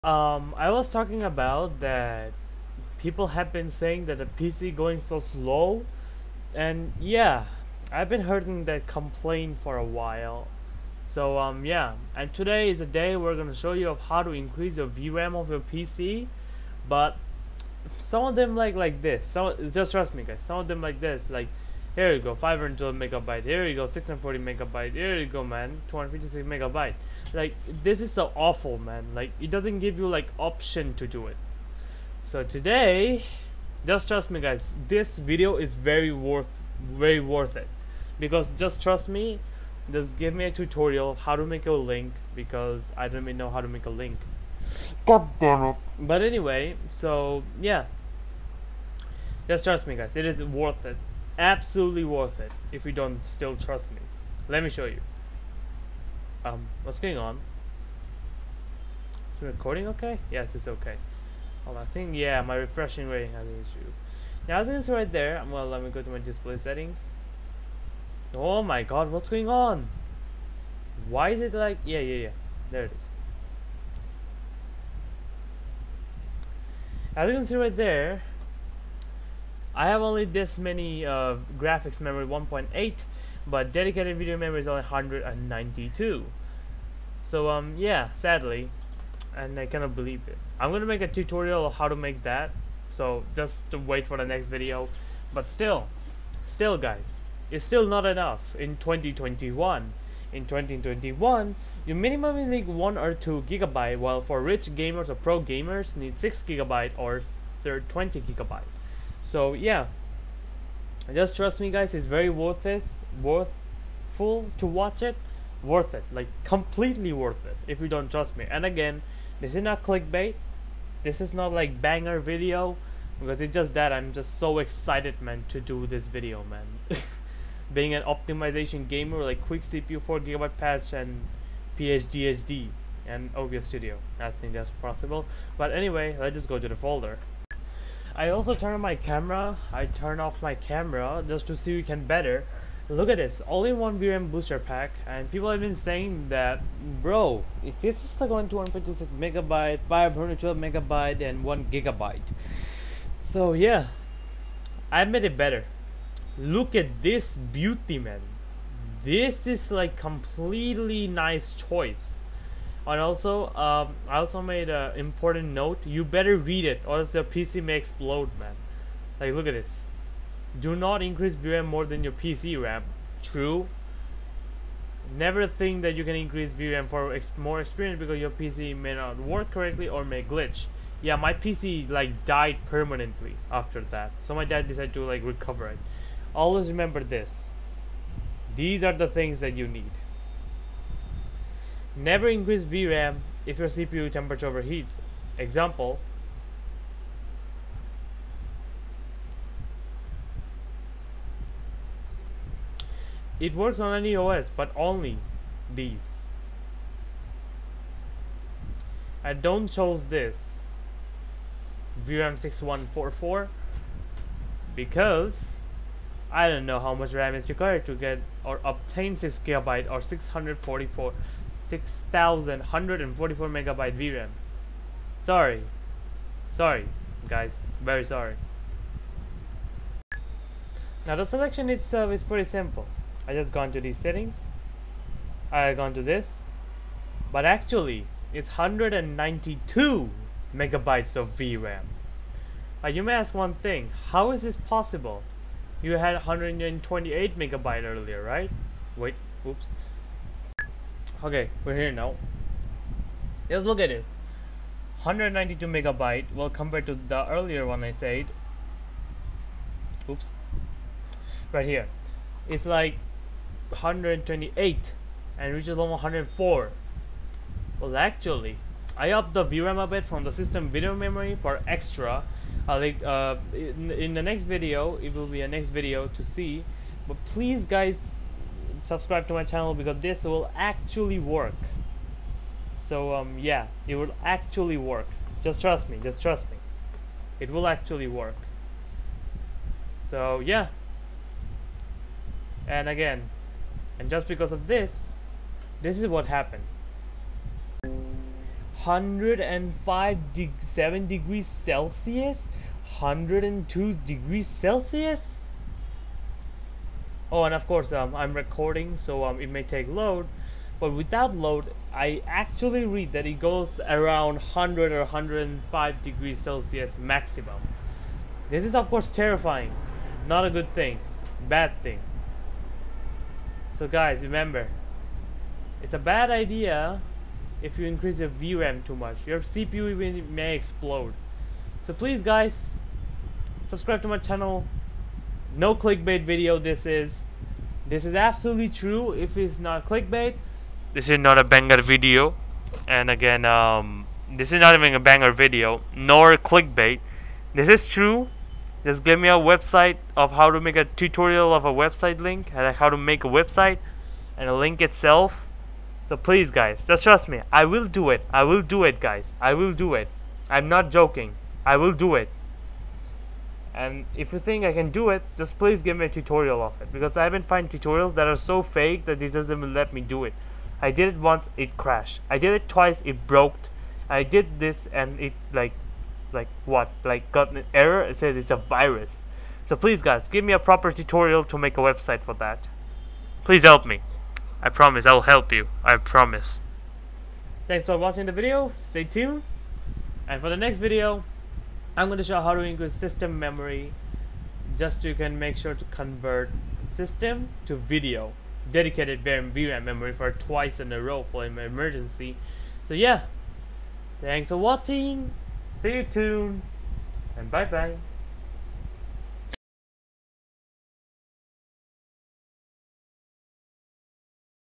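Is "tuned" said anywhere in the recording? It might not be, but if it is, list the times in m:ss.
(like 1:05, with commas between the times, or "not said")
6:29, 6:46.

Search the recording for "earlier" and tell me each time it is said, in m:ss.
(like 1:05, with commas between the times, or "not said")
4:07, 4:17.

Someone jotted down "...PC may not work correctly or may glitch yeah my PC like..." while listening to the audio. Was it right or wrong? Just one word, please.
right.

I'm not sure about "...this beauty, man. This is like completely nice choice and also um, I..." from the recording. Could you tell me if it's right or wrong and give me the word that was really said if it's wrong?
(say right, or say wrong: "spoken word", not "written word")
right.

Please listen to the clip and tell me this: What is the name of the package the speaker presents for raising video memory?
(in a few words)
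All in one VRAM booster pack.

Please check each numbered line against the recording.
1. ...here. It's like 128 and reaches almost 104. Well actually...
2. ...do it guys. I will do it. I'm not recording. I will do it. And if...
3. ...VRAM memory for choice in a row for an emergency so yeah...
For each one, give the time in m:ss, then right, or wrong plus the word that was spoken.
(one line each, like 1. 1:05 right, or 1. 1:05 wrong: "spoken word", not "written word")
1. 4:21 right
2. 5:58 wrong: "joking", not "recording"
3. 6:39 wrong: "twice", not "choice".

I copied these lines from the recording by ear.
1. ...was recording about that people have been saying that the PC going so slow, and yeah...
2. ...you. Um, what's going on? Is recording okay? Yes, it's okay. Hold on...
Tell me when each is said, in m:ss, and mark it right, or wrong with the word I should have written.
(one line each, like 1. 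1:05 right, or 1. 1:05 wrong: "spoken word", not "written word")
1. 0:00 wrong: "talking", not "recording"
2. 0:54 right.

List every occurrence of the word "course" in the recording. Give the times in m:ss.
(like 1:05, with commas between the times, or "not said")
5:07, 5:18.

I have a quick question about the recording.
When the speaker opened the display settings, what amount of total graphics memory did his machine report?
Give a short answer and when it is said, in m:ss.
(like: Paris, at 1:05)
1.8, at 1:22.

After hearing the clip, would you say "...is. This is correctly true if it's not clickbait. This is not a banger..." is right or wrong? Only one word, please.
wrong.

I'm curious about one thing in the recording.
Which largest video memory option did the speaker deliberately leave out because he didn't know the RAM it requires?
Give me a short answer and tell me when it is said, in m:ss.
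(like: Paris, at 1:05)
6144, at 3:32.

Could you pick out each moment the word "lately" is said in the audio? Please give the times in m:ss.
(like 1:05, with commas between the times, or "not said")
not said.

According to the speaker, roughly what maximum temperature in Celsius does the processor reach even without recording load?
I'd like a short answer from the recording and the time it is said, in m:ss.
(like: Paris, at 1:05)
105 degrees, at 5:15.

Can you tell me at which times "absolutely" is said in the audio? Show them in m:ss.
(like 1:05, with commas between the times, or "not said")
0:51, 5:38.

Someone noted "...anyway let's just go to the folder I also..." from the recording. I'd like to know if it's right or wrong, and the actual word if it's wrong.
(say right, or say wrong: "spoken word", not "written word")
right.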